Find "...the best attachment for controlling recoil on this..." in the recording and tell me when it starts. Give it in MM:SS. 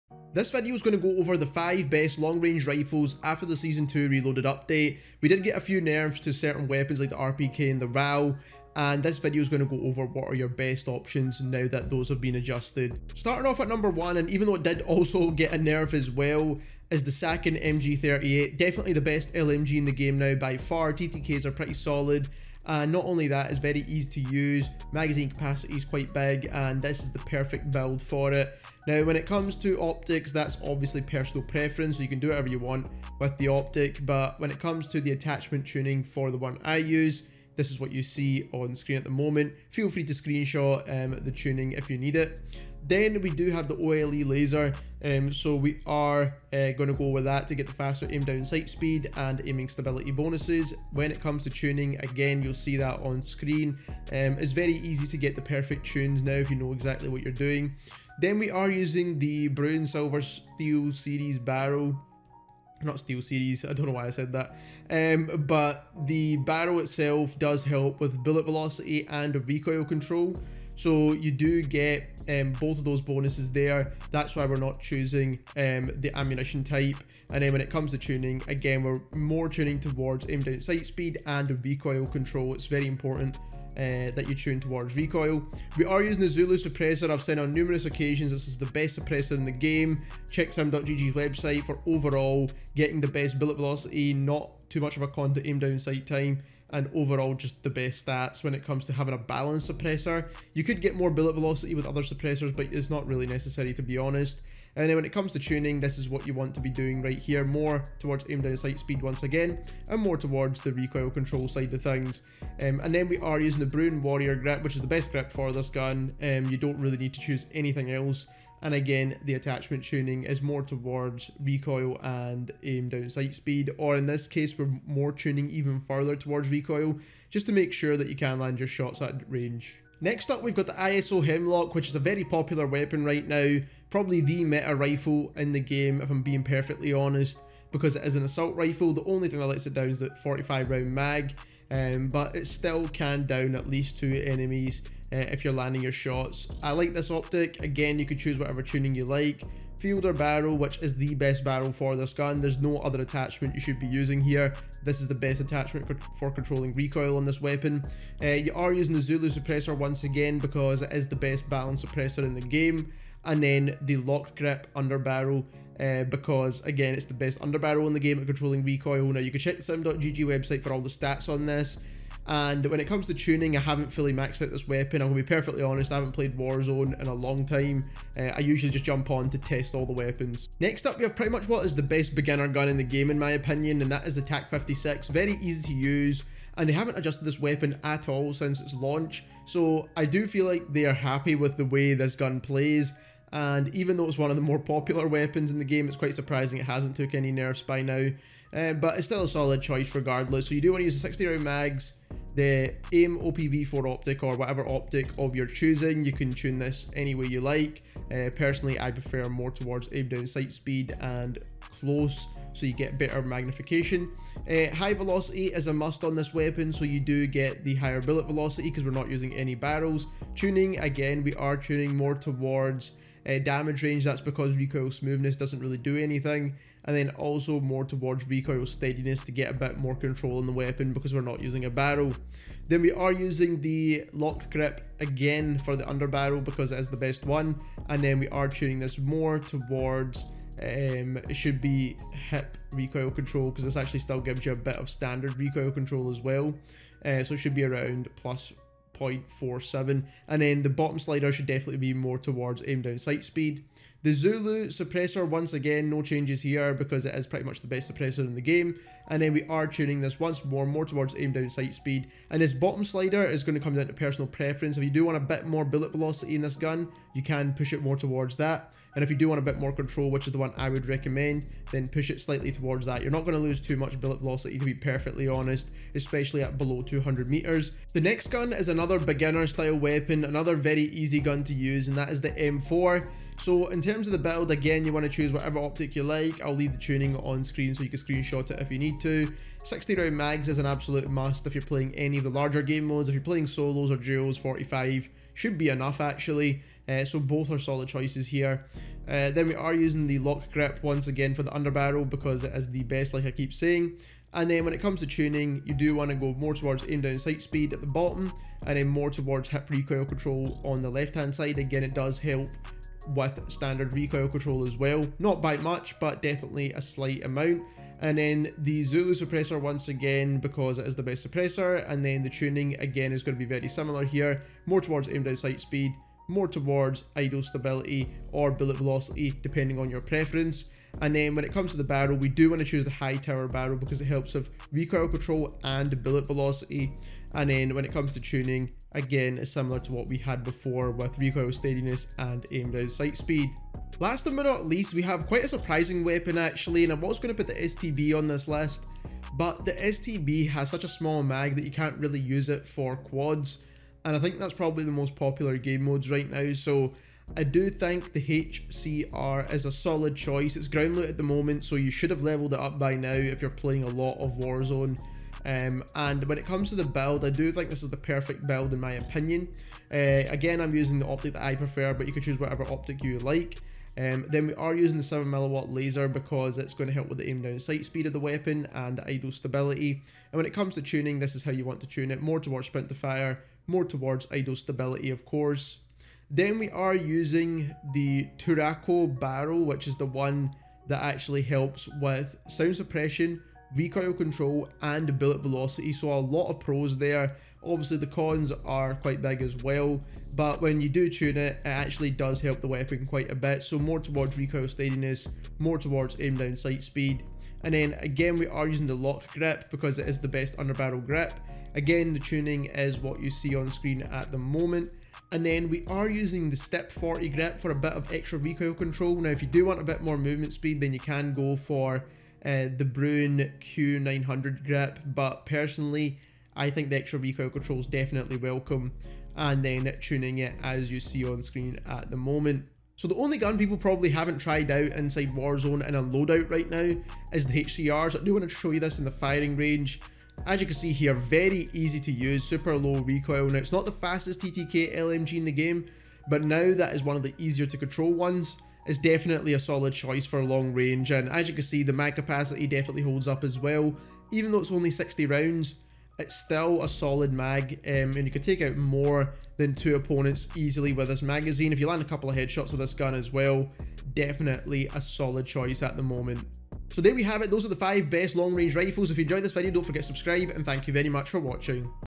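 02:35.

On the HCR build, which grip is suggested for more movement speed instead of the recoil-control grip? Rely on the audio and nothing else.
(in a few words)
Bruen Q900.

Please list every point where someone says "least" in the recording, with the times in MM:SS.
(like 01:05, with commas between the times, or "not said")
02:23, 05:44.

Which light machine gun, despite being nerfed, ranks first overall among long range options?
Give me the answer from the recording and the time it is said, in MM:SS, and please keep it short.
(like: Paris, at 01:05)
Sakin MG38, at 00:17.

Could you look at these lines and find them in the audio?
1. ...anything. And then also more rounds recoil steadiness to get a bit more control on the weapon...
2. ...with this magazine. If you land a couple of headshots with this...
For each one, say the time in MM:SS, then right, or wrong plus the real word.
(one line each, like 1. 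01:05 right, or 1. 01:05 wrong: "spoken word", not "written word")
1. 03:45 wrong: "towards", not "rounds"
2. 07:40 right.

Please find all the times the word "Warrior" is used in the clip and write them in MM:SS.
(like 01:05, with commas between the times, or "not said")
01:54.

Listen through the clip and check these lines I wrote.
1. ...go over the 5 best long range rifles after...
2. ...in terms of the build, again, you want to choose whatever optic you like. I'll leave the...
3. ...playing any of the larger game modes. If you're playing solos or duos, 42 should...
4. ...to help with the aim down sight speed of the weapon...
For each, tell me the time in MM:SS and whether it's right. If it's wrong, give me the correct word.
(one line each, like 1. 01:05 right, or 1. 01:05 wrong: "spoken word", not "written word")
1. 00:01 right
2. 04:43 right
3. 04:51 wrong: "45", not "42"
4. 06:16 right.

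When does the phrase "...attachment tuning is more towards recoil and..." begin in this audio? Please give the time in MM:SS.
01:59.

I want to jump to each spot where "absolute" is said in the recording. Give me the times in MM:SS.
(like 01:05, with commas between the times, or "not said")
04:50.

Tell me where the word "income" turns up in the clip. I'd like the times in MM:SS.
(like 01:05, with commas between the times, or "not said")
not said.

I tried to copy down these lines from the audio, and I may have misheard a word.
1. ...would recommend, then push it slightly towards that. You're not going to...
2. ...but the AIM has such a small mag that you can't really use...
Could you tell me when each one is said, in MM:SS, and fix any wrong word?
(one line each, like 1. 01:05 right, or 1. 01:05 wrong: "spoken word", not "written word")
1. 04:30 right
2. 05:49 wrong: "STB", not "AIM".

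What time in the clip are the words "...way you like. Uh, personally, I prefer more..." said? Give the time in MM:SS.
03:27.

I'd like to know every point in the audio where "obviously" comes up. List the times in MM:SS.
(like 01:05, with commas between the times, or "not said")
00:30, 06:37.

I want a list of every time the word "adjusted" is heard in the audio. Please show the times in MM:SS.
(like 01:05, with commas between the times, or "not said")
00:12, 03:06.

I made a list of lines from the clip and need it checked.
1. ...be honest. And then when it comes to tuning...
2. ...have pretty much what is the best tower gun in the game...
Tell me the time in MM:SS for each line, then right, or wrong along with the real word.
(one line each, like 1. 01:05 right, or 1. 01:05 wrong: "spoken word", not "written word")
1. 01:43 right
2. 03:01 wrong: "beginner", not "tower".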